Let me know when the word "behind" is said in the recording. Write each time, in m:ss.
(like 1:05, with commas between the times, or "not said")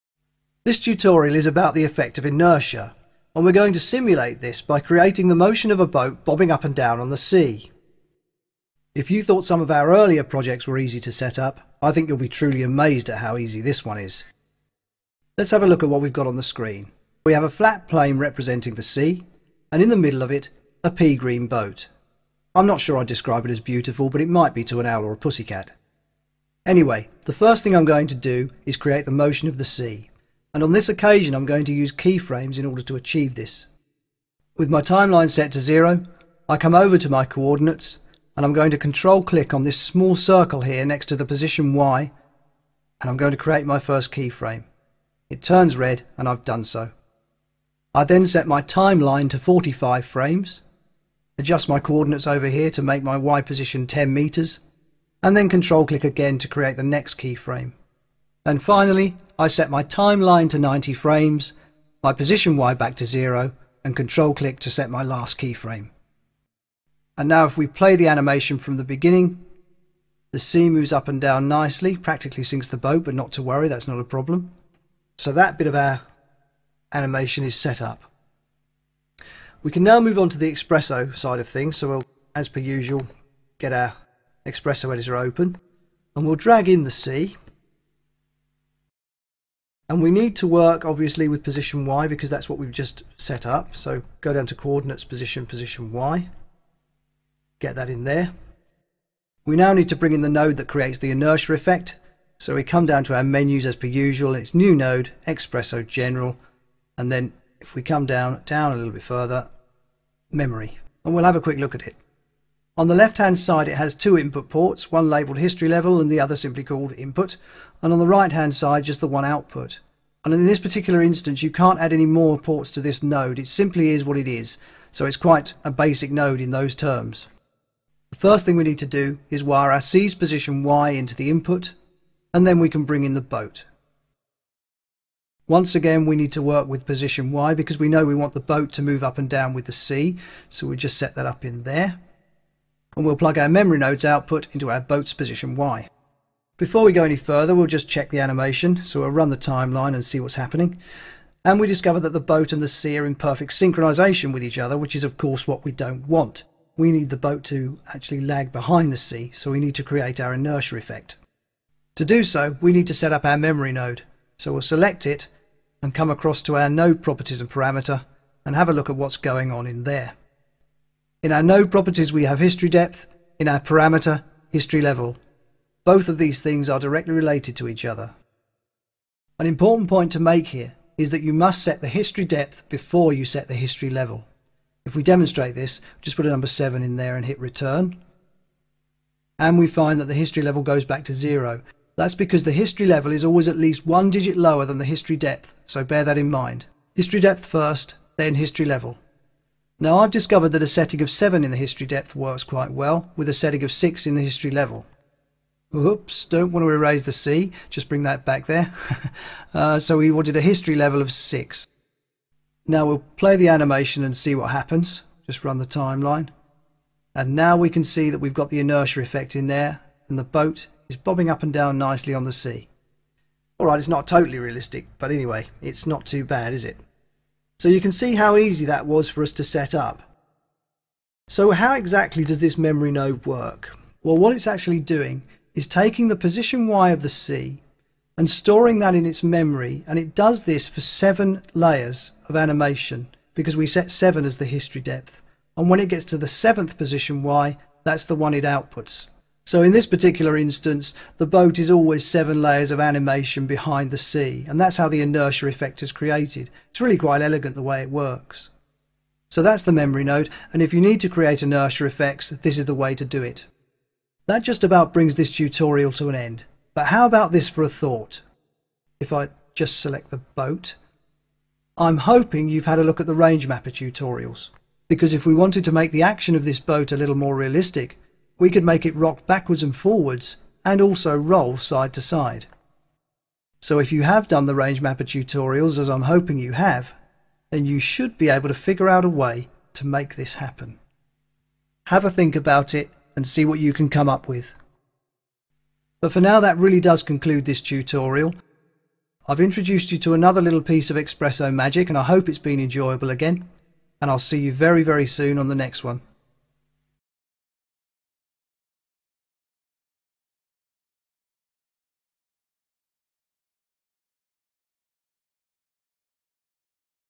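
2:38, 4:13.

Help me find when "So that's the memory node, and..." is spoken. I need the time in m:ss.
4:19.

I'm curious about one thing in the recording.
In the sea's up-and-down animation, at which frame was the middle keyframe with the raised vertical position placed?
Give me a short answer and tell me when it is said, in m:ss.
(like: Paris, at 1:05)
45, at 0:49.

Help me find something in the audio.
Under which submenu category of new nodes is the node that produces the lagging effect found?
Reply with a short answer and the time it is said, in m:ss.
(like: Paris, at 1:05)
Xpresso General, at 1:45.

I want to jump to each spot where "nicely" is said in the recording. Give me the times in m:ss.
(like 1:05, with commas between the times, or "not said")
1:11, 3:41.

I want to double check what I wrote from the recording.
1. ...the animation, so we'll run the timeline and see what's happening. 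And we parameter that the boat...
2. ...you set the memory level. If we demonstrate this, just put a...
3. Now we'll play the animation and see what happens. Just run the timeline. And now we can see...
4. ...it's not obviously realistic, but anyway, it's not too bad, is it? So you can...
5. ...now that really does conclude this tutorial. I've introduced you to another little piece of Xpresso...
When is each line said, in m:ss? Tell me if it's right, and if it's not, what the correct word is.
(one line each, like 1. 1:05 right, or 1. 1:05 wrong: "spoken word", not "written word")
1. 2:28 wrong: "discover", not "parameter"
2. 3:03 wrong: "history", not "memory"
3. 3:32 right
4. 3:43 wrong: "totally", not "obviously"
5. 4:56 right.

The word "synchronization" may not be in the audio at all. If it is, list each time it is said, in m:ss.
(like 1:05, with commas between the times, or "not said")
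2:33.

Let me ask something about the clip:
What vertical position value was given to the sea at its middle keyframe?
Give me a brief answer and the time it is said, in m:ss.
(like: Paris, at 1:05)
10 meters, at 0:53.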